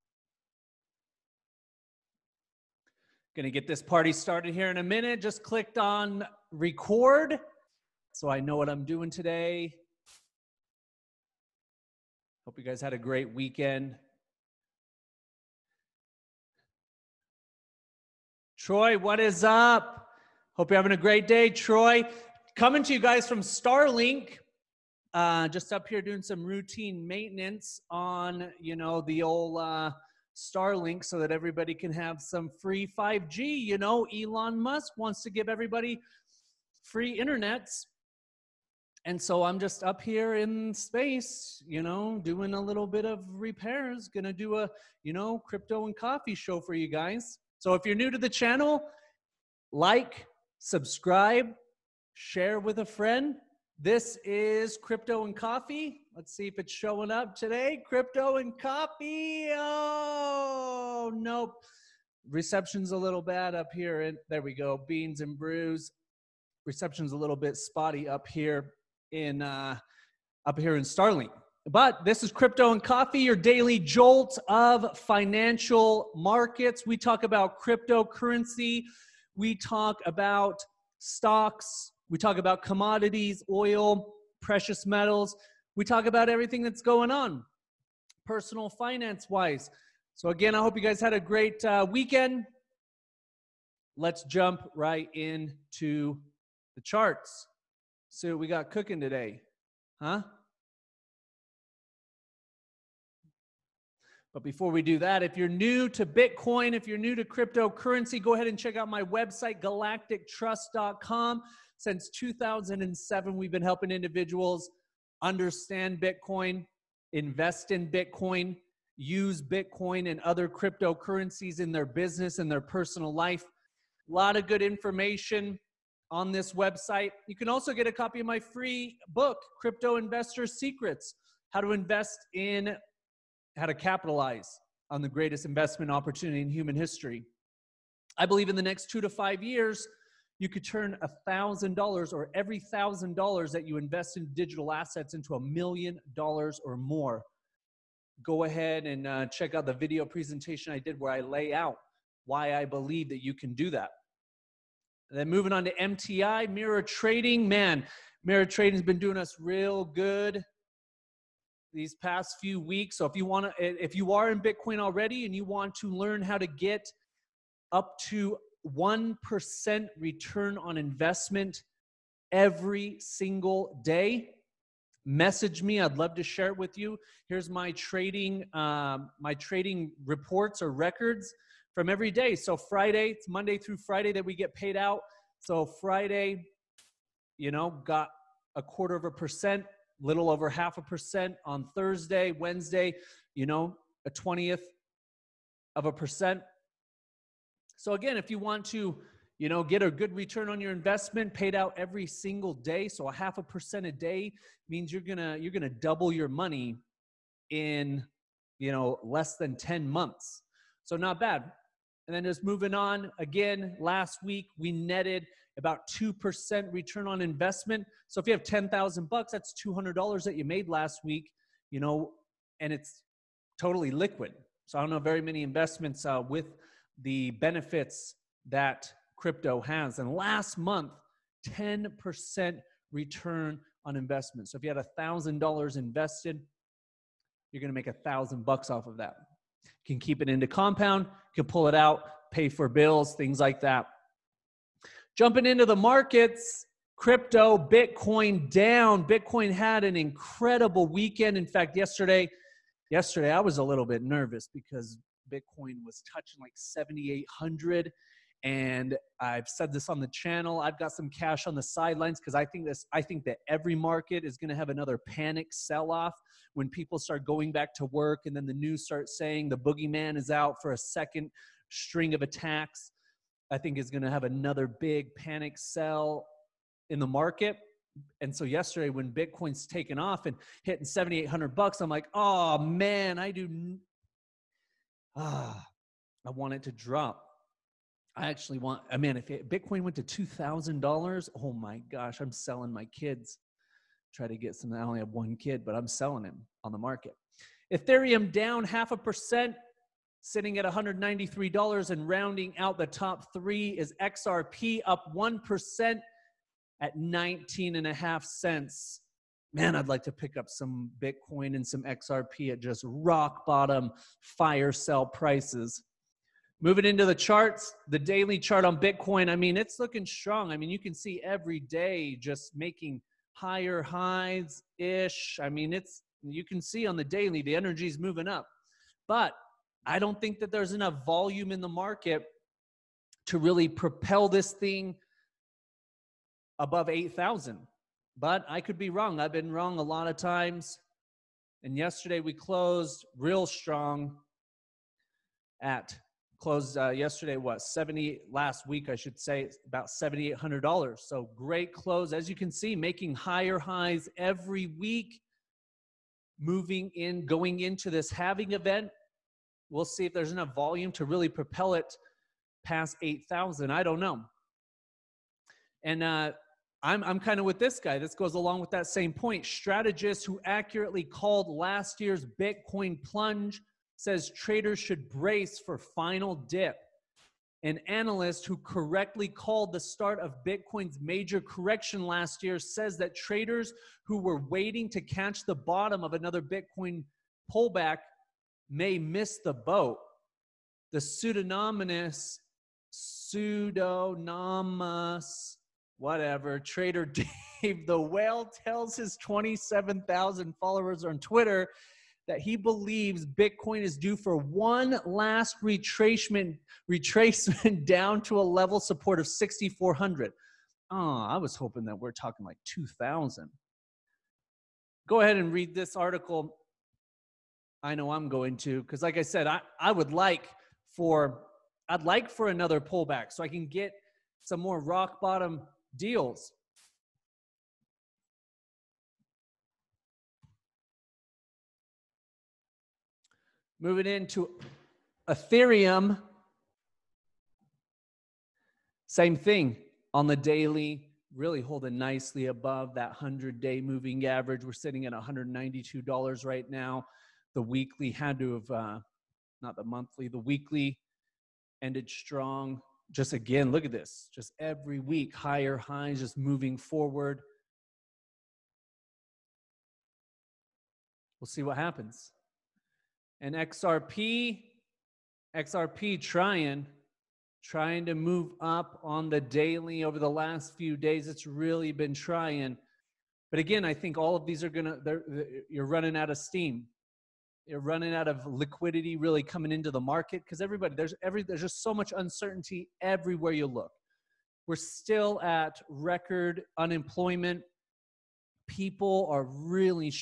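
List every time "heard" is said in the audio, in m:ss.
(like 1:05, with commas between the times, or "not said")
not said.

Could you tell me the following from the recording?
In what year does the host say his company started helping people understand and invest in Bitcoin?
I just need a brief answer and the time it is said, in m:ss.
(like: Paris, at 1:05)
2007, at 1:51.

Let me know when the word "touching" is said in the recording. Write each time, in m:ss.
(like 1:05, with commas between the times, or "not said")
4:16.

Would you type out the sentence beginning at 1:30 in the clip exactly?
So, again, I hope you guys had a great uh, weekend.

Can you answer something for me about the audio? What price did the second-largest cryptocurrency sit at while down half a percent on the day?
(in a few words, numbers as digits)
$193.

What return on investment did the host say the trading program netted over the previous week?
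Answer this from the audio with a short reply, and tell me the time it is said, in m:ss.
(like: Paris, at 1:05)
2%, at 3:35.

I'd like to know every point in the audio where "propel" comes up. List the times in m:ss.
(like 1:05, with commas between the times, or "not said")
5:33, 6:01.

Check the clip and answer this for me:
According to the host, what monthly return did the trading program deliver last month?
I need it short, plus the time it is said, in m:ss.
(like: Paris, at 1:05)
10%, at 3:50.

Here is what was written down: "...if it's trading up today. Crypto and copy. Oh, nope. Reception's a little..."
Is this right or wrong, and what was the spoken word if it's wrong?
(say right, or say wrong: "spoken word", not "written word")
wrong: "showing", not "trading".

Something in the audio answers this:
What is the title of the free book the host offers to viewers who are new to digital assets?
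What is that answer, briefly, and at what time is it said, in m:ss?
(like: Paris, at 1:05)
Crypto Investor Secrets, at 2:09.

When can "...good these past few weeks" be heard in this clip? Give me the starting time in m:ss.
2:39.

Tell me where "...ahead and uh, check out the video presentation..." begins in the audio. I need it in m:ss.
2:28.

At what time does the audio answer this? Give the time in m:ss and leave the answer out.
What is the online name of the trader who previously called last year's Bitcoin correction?
6:37.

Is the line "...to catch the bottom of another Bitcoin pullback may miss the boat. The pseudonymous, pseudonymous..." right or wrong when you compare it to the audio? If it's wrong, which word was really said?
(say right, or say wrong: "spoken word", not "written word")
right.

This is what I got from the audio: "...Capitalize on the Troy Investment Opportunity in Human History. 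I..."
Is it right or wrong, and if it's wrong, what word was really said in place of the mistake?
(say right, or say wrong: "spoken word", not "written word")
wrong: "Greatest", not "Troy".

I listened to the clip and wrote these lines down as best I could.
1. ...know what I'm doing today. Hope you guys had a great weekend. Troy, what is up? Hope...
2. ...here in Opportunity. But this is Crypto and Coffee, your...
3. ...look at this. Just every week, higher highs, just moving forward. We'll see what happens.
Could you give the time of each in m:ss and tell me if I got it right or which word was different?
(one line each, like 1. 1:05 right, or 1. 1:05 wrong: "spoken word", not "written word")
1. 0:08 right
2. 1:10 wrong: "Starlink", not "Opportunity"
3. 7:33 right.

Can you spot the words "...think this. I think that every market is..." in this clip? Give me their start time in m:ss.
4:22.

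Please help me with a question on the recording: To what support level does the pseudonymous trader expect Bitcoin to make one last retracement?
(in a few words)
6,400.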